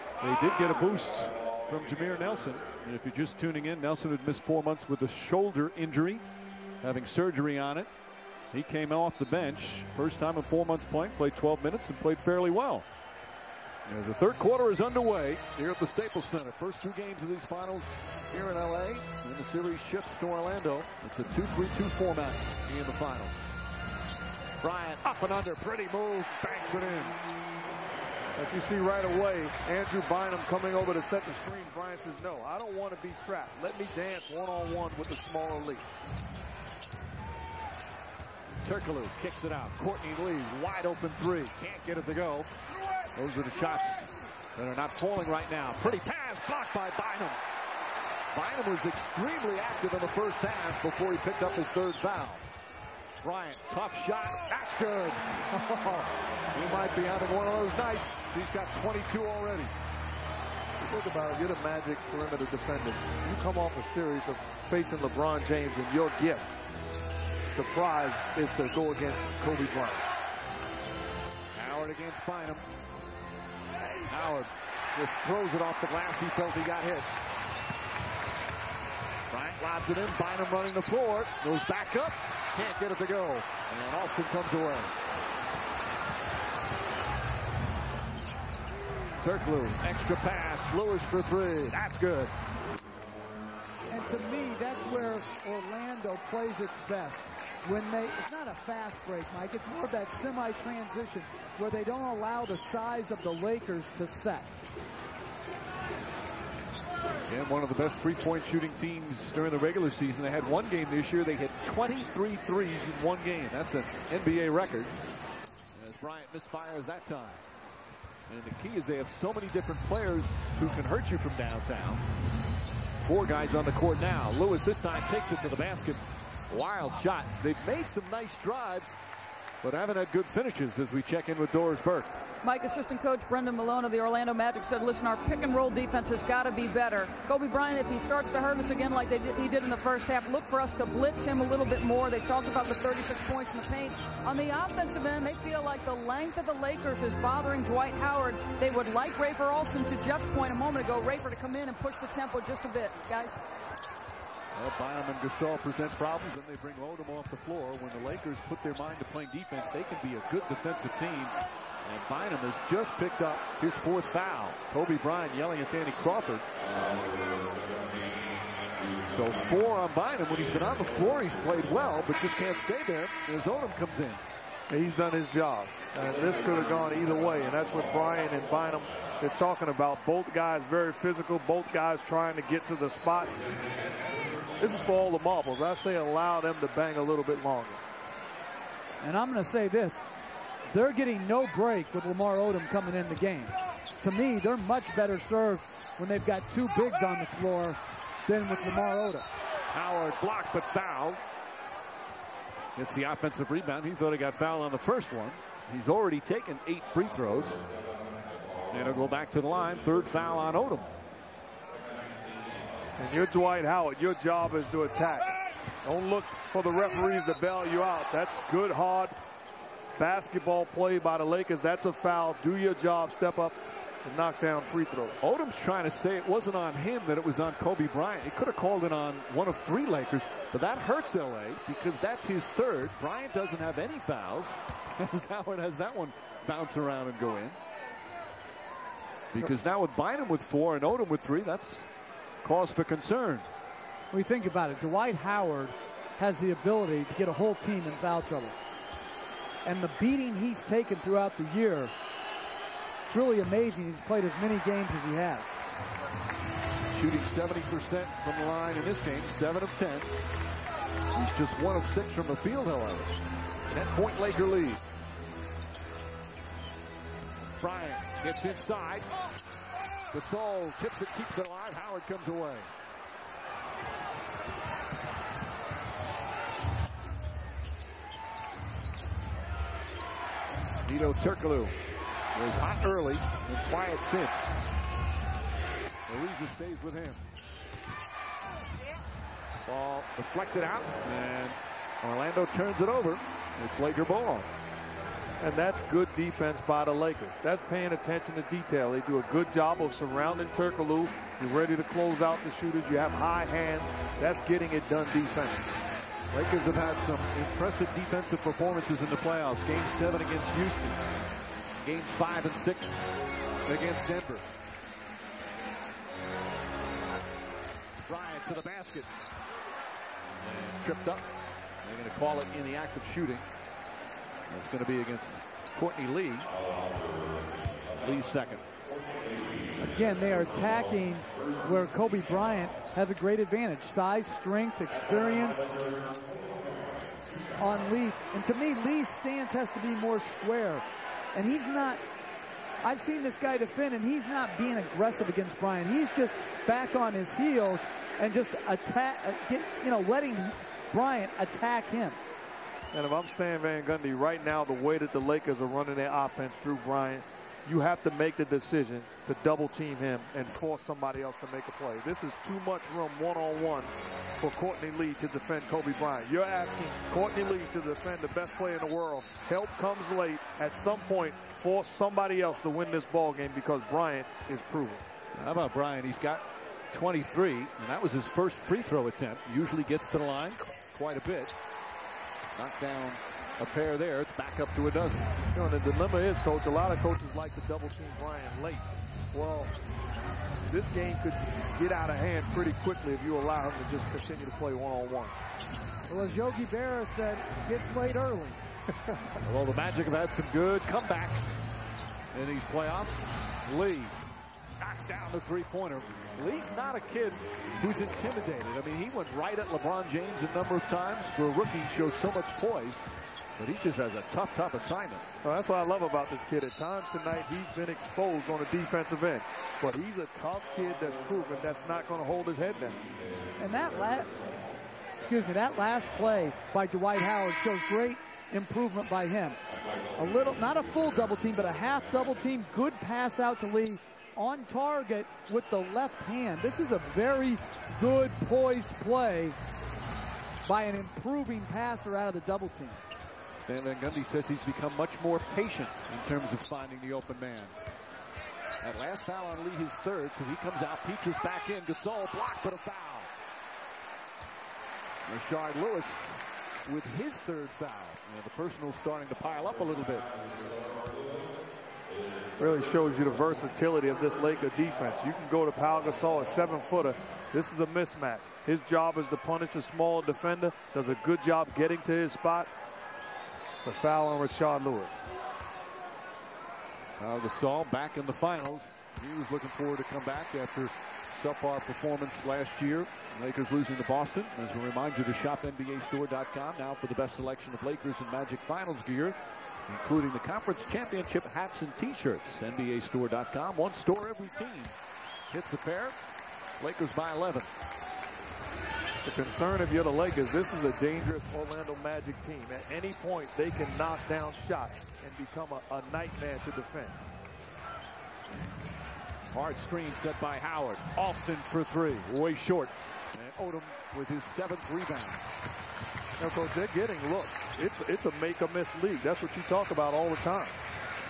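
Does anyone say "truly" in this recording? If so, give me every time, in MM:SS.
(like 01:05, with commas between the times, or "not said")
04:13.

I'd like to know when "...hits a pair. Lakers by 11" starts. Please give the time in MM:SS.
08:15.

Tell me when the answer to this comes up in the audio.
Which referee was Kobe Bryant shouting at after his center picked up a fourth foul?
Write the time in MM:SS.
02:45.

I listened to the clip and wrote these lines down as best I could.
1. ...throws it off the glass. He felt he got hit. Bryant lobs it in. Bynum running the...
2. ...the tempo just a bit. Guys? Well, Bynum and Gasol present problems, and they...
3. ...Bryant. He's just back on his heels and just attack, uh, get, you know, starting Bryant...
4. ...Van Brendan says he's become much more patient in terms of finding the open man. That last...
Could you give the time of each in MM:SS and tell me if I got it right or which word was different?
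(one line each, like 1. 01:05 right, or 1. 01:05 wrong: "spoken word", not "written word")
1. 01:15 right
2. 02:31 right
3. 05:45 wrong: "letting", not "starting"
4. 07:23 wrong: "Gundy", not "Brendan".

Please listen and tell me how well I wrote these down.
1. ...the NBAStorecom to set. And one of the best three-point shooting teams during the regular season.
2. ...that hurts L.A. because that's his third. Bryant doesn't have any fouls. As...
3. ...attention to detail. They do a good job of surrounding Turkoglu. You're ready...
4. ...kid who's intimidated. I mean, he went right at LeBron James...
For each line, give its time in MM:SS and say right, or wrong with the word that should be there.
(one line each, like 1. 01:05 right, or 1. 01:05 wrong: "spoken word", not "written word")
1. 01:43 wrong: "Lakers", not "NBAStorecom"
2. 03:50 right
3. 04:57 right
4. 06:47 right.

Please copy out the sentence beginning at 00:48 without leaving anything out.
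Bynum was extremely active in the first half before he picked up his third foul.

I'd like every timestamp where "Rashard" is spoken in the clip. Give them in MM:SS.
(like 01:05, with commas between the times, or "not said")
07:35, 07:54.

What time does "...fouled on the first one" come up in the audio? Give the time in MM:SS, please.
03:24.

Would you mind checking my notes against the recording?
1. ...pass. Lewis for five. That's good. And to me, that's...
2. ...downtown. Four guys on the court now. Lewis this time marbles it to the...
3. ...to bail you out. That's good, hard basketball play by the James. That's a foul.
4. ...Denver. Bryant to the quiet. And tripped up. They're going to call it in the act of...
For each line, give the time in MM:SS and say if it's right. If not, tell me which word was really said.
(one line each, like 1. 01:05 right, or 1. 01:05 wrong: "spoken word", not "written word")
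1. 01:30 wrong: "three", not "five"
2. 02:01 wrong: "takes", not "marbles"
3. 03:37 wrong: "Lakers", not "James"
4. 05:14 wrong: "basket", not "quiet".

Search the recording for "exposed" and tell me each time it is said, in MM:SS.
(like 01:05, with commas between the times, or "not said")
06:57.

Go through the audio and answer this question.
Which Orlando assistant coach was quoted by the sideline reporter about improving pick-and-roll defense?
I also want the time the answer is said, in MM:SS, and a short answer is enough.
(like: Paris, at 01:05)
Brendan Malone, at 02:13.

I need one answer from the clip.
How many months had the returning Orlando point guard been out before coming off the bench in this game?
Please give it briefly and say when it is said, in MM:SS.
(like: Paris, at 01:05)
4, at 00:04.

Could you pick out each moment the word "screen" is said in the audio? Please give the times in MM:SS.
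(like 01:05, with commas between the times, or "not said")
00:31, 08:29.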